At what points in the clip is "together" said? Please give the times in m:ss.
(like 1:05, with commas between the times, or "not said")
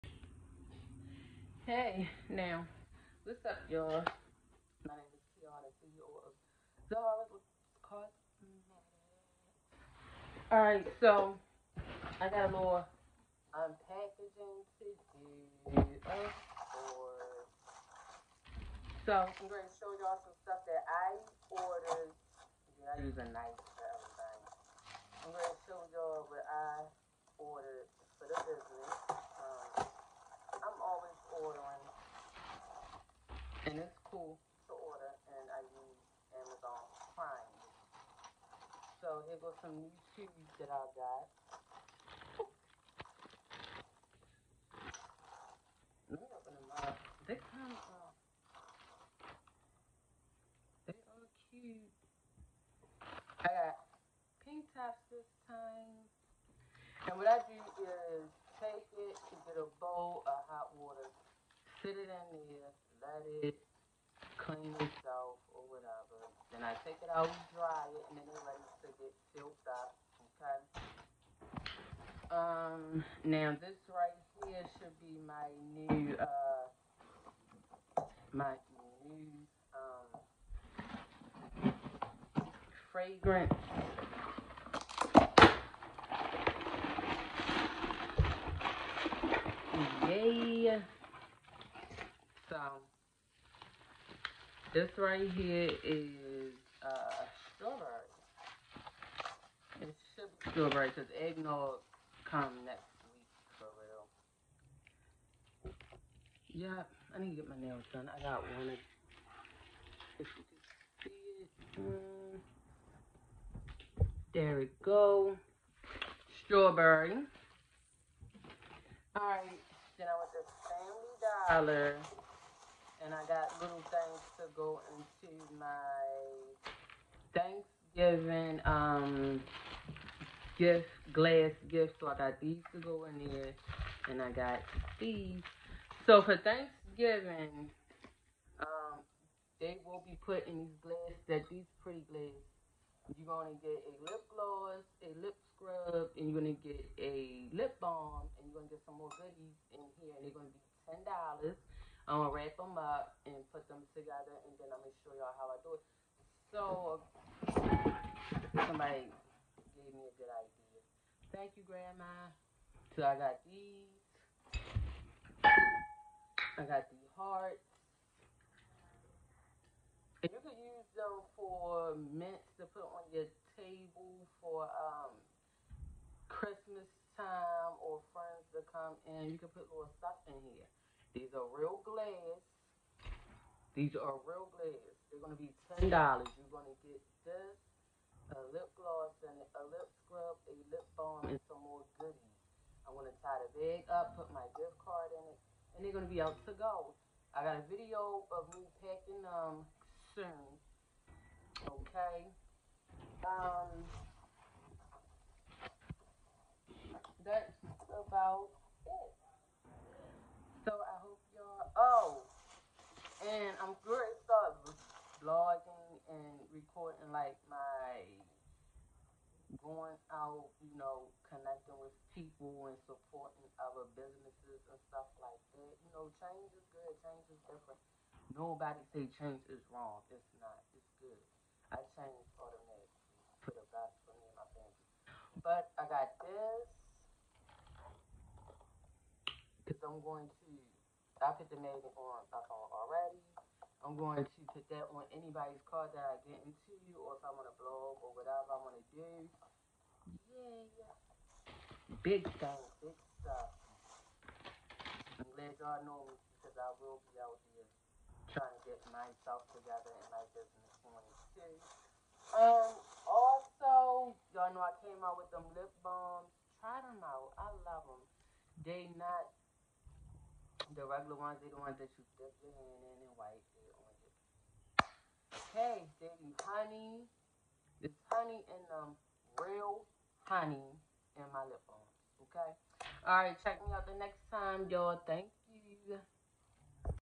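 2:33, 4:19.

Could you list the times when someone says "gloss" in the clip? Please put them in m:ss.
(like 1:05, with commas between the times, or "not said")
2:24, 3:08.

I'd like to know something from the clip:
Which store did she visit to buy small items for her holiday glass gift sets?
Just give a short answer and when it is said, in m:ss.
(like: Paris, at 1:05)
Family Dollar, at 2:00.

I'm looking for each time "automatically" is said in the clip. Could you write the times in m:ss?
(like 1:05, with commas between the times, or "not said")
3:52.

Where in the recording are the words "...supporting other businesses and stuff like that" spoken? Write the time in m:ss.
3:42.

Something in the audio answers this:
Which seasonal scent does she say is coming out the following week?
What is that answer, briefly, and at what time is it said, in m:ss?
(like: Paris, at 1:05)
Eggnog, at 1:41.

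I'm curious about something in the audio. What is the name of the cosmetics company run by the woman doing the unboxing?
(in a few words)
Zahara's Cosmetics.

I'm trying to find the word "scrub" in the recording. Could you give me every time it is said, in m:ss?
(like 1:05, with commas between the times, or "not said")
2:25, 3:10.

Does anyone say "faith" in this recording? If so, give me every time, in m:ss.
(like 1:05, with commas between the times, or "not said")
not said.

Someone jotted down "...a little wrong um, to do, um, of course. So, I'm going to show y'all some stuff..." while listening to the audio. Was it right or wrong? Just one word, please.
wrong.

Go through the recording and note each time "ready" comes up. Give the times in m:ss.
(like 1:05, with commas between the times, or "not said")
1:08.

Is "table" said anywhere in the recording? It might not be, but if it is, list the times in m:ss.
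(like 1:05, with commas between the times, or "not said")
2:53.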